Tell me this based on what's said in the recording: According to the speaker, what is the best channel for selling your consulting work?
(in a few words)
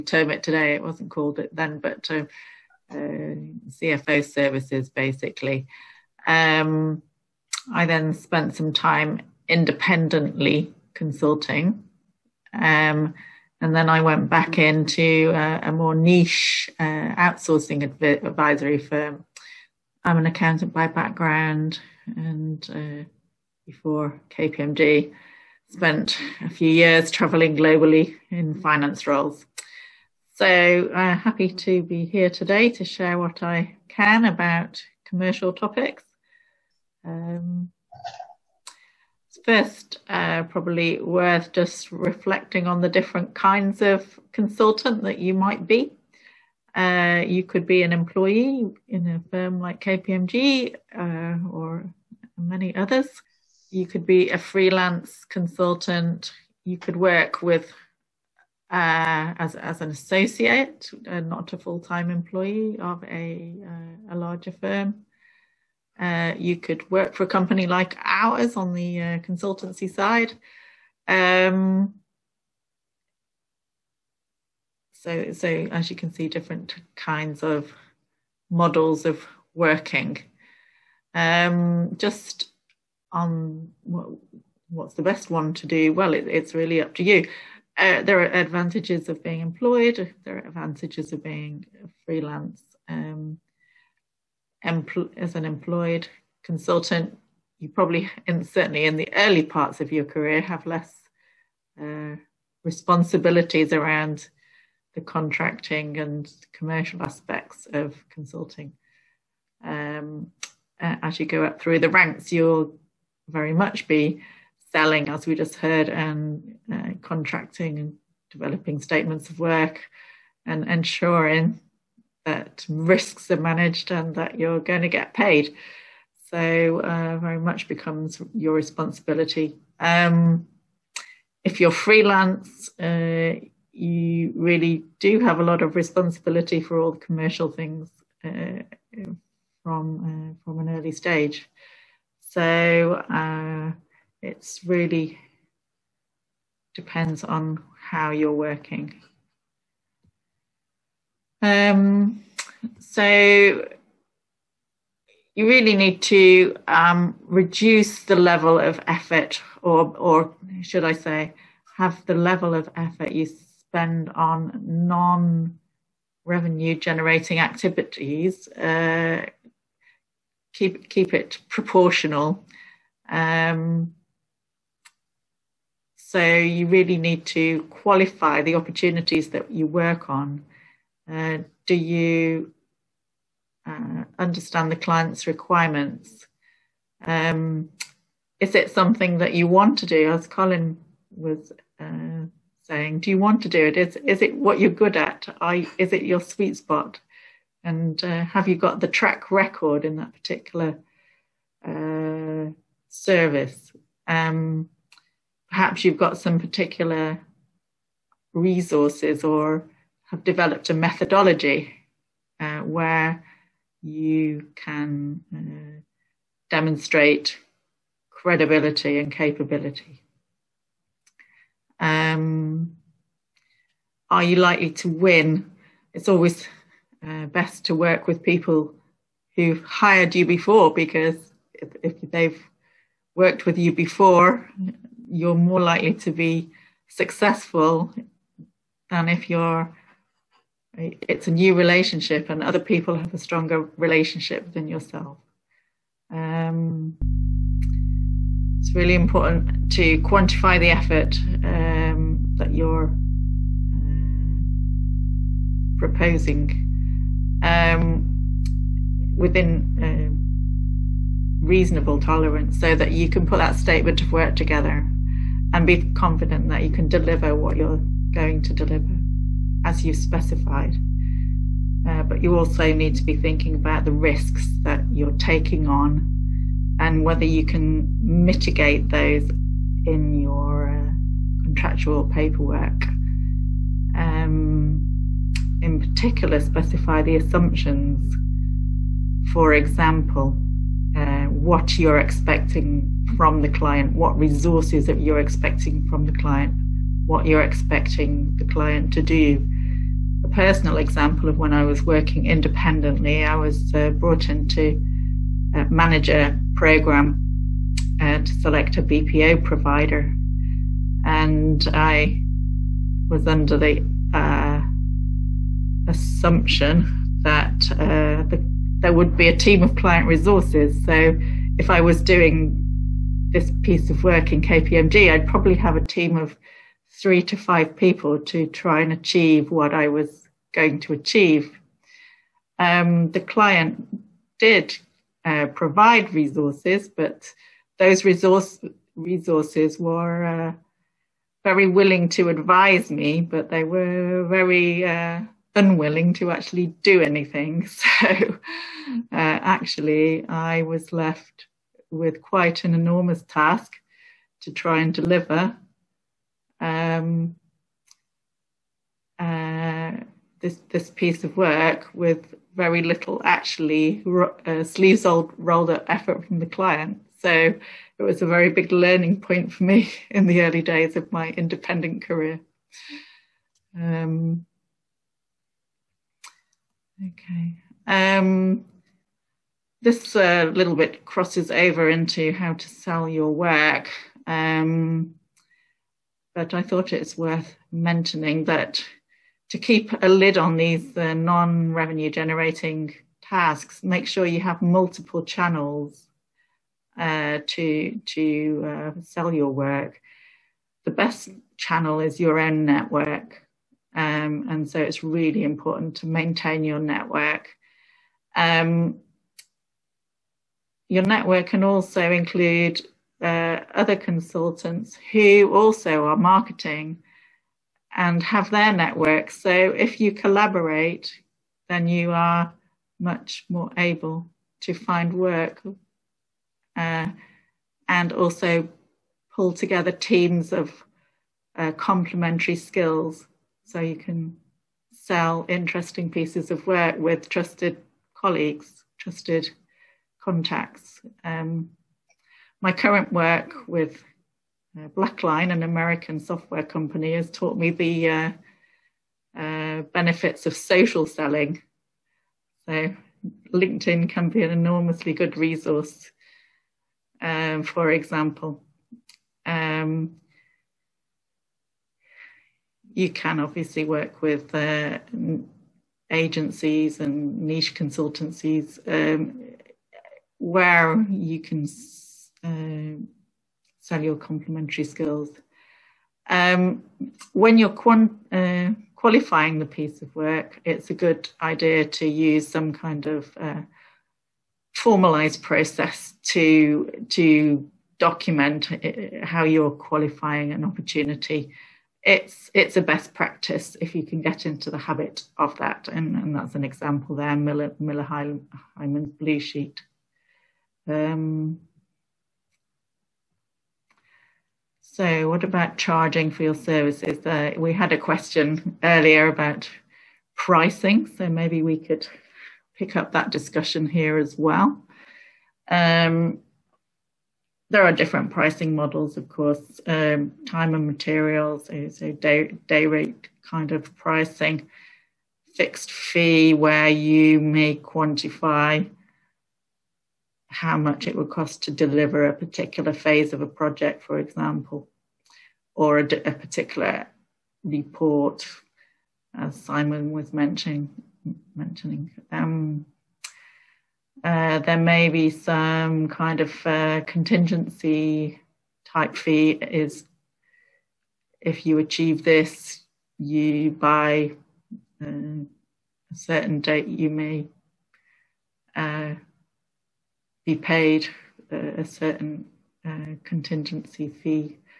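Your own network.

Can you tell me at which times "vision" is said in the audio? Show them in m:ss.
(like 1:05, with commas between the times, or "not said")
not said.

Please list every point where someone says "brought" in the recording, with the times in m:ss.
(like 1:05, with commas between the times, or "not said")
5:03.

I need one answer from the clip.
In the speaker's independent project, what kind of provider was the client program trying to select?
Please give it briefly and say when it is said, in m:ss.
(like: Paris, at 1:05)
BPO provider, at 5:08.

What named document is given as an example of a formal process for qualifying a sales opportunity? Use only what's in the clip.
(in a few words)
Miller Heiman's blue sheet.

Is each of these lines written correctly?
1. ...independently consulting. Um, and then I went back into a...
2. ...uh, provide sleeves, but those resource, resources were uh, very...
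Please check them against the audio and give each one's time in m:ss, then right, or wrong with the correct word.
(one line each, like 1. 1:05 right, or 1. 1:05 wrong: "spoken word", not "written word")
1. 0:09 right
2. 5:35 wrong: "resources", not "sleeves".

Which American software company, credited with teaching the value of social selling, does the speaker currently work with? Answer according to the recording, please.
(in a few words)
Blackline.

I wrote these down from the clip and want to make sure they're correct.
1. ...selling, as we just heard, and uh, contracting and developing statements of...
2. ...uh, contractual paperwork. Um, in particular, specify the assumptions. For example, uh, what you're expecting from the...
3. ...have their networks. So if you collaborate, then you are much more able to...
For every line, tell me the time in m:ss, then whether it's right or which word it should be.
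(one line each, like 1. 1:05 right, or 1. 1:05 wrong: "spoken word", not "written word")
1. 1:54 right
2. 4:40 right
3. 6:58 right.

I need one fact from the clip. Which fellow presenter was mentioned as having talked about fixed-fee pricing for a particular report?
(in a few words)
Simon.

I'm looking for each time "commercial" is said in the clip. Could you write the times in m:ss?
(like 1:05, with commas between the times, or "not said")
0:35, 1:46, 2:16.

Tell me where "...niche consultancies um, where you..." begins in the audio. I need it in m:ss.
7:47.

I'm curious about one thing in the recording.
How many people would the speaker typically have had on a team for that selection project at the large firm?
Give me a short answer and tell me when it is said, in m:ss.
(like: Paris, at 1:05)
3 to 5, at 5:26.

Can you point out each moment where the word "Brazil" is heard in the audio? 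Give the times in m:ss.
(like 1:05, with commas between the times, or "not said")
not said.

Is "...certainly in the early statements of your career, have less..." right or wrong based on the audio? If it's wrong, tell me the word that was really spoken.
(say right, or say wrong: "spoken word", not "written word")
wrong: "parts", not "statements".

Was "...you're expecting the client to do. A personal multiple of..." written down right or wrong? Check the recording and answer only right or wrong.
wrong.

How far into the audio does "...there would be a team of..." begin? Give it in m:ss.
5:18.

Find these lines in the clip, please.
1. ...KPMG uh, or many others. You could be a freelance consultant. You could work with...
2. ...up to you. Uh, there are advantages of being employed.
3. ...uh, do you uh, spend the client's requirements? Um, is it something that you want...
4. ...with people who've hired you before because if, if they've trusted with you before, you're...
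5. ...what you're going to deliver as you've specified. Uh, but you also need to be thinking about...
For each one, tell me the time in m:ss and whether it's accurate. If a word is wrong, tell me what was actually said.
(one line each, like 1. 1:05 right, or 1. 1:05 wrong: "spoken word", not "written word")
1. 0:49 right
2. 1:26 right
3. 3:01 wrong: "understand", not "spend"
4. 3:48 wrong: "worked", not "trusted"
5. 4:27 right.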